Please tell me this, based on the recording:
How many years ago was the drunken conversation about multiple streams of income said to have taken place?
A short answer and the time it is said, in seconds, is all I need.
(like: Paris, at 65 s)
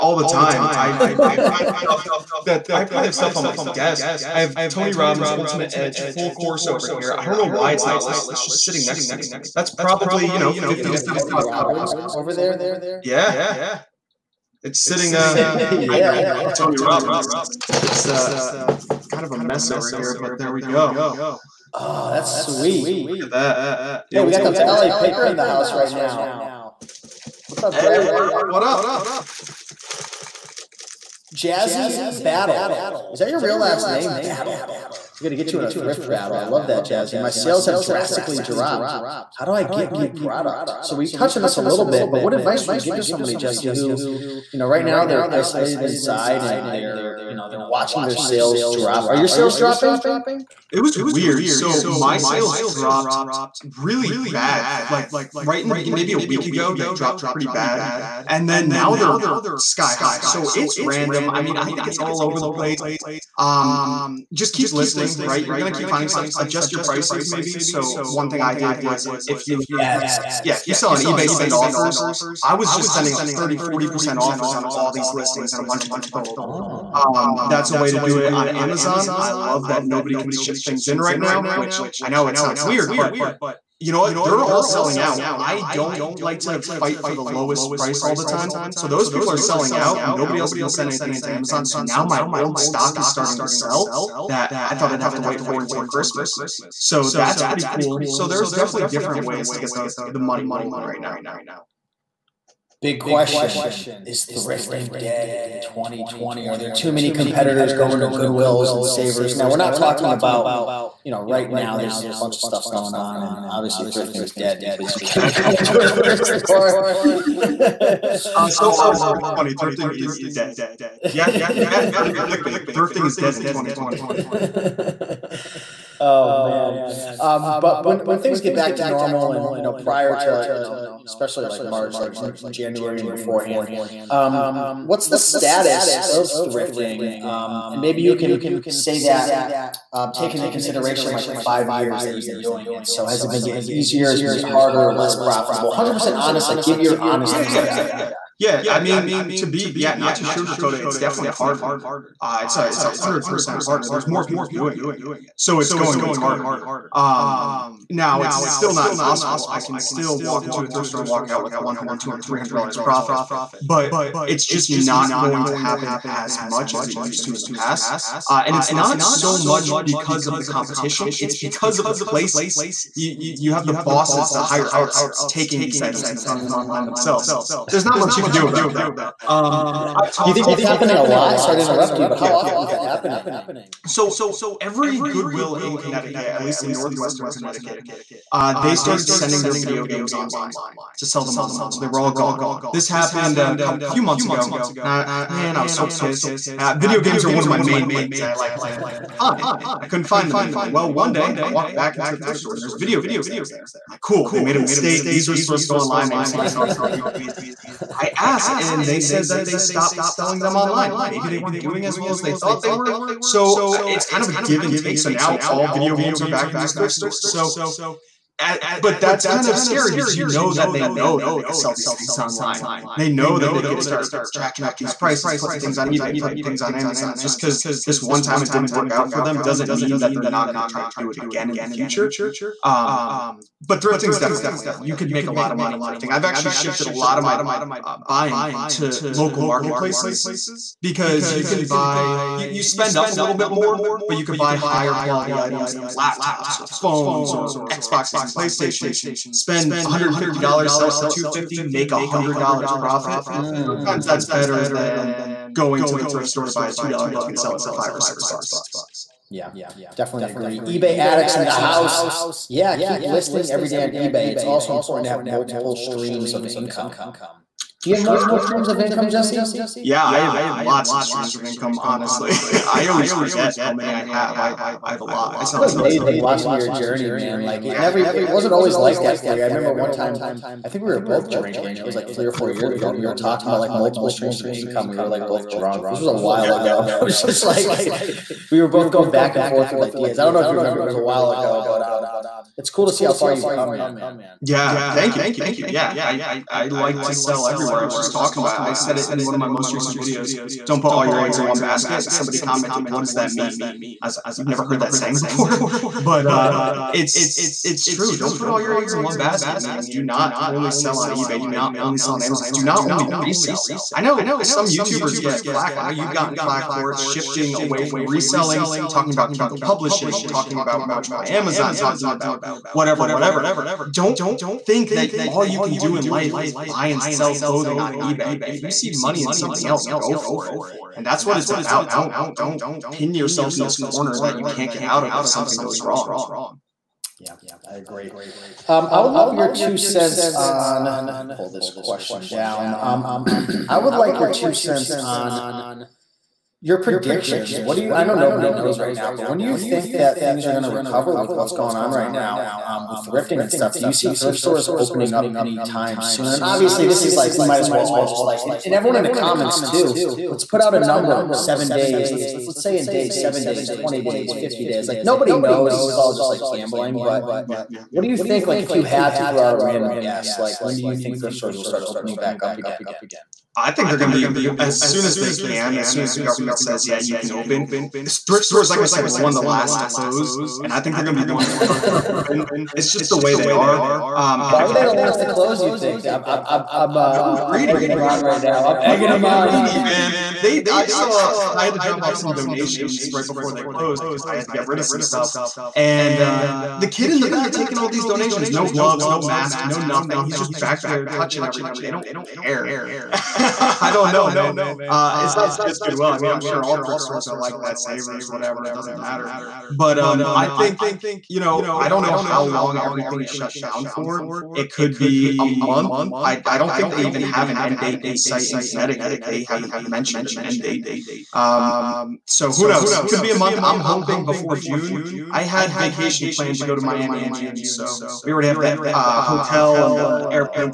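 three or four years, at 282 s.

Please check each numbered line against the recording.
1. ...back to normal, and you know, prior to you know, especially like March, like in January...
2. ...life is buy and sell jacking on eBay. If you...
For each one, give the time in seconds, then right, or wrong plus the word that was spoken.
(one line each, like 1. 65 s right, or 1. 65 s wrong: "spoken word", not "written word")
1. 128 s right
2. 326 s wrong: "clothing", not "jacking".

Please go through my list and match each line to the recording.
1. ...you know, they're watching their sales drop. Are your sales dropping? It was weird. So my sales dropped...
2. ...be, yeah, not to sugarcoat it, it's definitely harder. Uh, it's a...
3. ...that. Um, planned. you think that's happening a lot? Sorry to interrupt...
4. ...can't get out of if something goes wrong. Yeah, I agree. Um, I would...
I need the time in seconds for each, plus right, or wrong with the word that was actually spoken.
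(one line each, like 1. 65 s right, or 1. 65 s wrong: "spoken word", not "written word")
1. 47 s right
2. 149 s right
3. 178 s wrong: "talked", not "planned"
4. 334 s right.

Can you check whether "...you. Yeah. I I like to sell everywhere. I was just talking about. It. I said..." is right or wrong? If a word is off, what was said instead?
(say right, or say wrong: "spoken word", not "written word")
right.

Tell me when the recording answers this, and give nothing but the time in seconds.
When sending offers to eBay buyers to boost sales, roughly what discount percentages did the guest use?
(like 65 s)
73 s.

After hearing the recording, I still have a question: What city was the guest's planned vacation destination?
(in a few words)
Miami.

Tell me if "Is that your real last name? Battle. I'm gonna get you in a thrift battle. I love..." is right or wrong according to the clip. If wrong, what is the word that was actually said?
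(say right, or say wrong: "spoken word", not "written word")
right.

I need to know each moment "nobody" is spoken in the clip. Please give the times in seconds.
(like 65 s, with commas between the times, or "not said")
79 s, 90 s, 348 s, 365 s.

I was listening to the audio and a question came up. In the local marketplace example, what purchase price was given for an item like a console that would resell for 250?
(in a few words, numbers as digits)
$150.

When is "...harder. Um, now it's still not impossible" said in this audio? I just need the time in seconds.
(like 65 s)
156 s.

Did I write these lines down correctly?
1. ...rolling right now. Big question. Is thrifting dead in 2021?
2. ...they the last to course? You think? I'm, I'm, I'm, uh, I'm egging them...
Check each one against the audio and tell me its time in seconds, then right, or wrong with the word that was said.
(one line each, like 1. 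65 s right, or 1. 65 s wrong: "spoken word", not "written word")
1. 100 s wrong: "2020", not "2021"
2. 384 s wrong: "close", not "course".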